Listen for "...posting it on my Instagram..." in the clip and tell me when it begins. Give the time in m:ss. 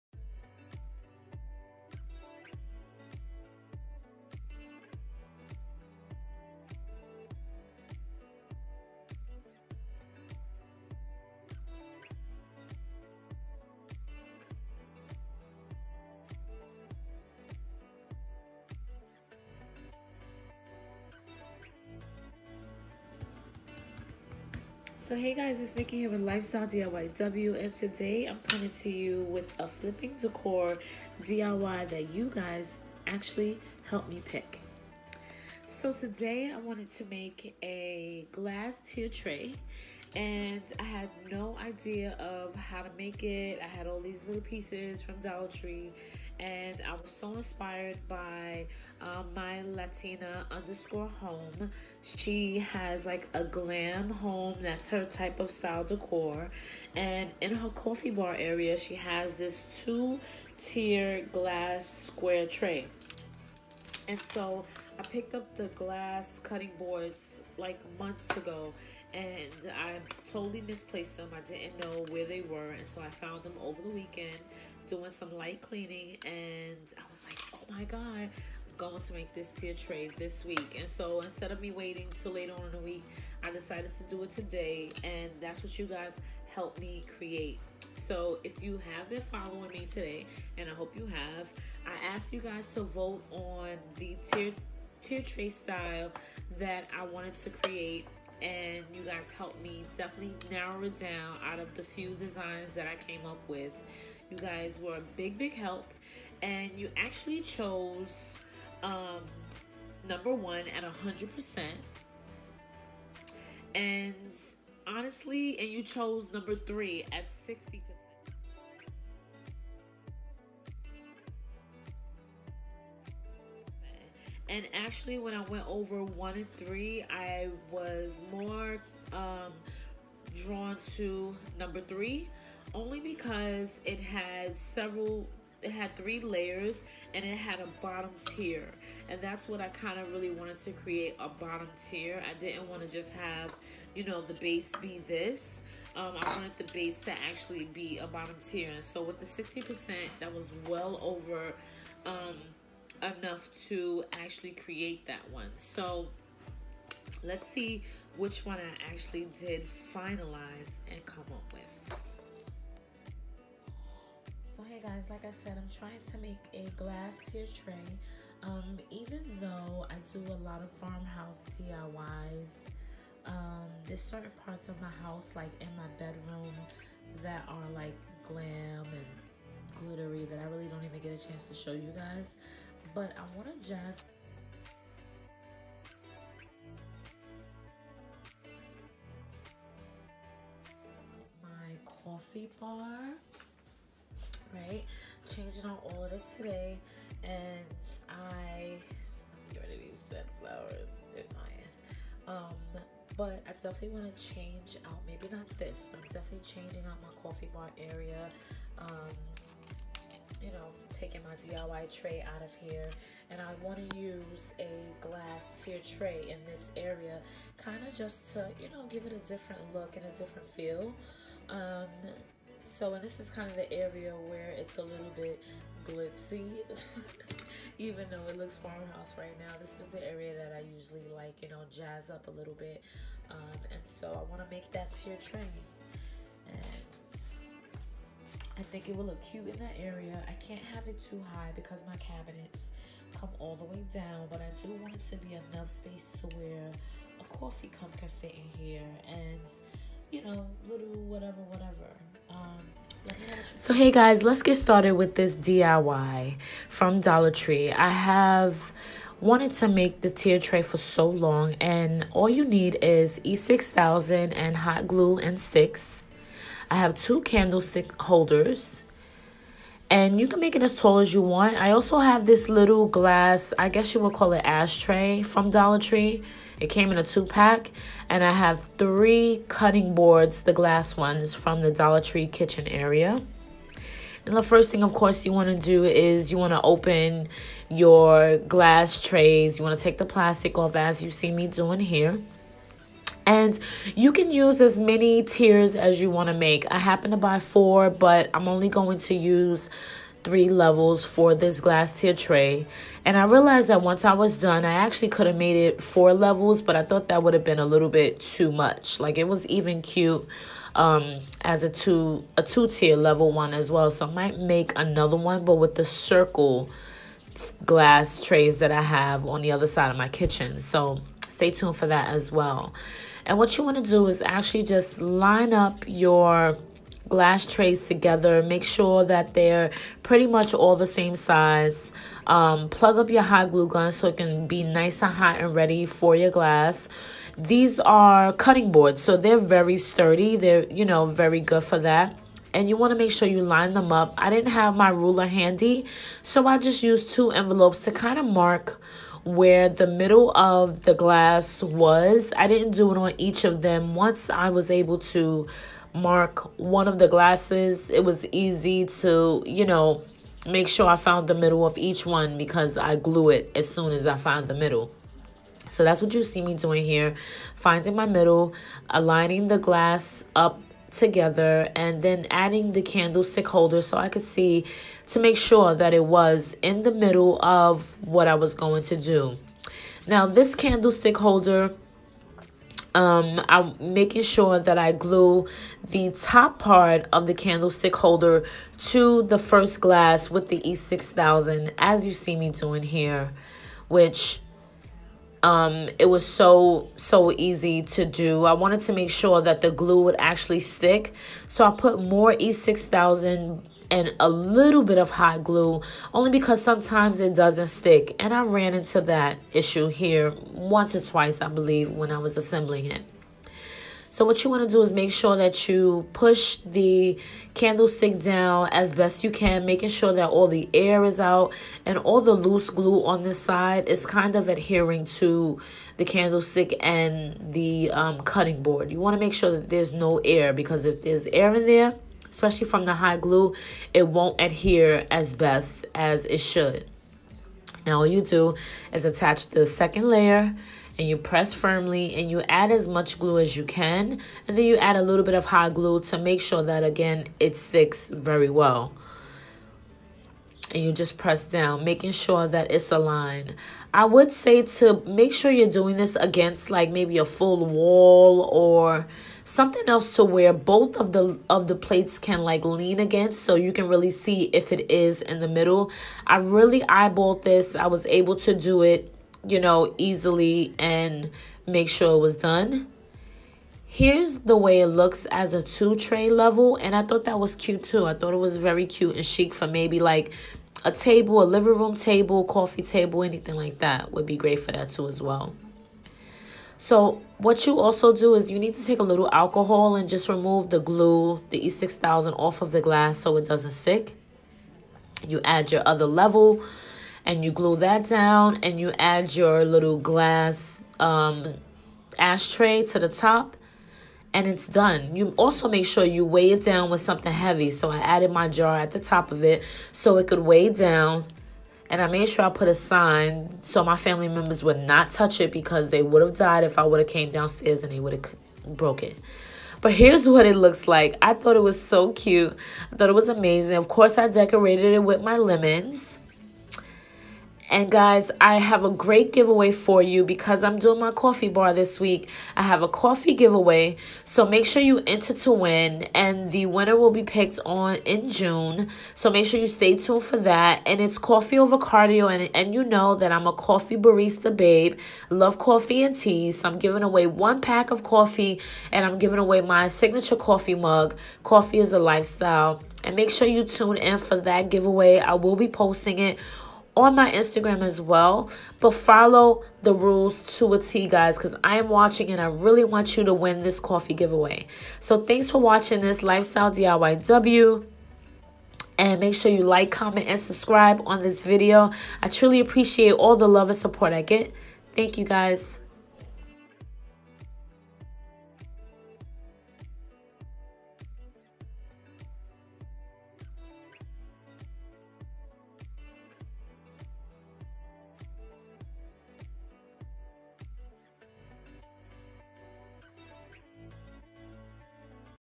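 9:15.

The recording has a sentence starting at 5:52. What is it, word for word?
I didn't do it on each of them.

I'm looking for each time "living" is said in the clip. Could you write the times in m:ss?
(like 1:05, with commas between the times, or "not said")
8:01.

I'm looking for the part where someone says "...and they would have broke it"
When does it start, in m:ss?
8:37.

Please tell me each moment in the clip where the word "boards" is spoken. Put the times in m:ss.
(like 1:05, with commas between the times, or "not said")
1:06, 4:39, 5:38, 7:08.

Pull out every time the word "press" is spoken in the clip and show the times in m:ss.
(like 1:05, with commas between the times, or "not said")
7:21, 7:31.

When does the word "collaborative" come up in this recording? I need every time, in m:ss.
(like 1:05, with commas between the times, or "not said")
not said.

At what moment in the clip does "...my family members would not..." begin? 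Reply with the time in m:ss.
8:33.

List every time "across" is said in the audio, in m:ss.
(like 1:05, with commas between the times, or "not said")
not said.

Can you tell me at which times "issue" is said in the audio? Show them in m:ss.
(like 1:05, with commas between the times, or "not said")
6:49.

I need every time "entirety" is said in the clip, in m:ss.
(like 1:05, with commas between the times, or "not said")
not said.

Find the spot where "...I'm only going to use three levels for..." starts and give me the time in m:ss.
4:58.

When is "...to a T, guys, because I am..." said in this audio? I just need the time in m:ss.
9:20.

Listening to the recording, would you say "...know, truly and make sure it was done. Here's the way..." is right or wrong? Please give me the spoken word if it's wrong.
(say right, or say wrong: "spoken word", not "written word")
wrong: "easily", not "truly".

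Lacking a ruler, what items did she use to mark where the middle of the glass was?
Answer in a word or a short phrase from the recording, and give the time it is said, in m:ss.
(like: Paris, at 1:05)
two envelopes, at 5:47.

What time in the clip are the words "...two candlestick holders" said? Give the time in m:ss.
4:26.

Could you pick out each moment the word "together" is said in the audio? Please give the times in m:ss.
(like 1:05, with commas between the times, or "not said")
5:27, 6:10.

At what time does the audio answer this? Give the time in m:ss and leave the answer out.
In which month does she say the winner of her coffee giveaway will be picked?
8:58.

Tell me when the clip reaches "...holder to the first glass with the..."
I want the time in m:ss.
6:27.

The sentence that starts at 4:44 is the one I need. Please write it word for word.
And the first thing, of course, you want to do is you want to open your glass trays.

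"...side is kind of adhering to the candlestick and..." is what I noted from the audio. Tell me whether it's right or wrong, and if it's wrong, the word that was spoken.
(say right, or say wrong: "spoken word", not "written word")
right.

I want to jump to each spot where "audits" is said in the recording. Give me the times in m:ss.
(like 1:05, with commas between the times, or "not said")
not said.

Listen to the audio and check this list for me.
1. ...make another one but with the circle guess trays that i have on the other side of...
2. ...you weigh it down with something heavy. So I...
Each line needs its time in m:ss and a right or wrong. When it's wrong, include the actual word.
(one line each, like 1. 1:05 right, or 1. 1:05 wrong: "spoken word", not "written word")
1. 5:14 wrong: "glass", not "guess"
2. 8:26 right.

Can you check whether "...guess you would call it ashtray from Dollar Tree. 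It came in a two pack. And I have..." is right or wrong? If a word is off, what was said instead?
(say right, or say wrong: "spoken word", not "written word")
right.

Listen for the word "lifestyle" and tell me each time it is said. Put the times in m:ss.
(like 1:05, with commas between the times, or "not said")
0:26, 9:11, 9:26.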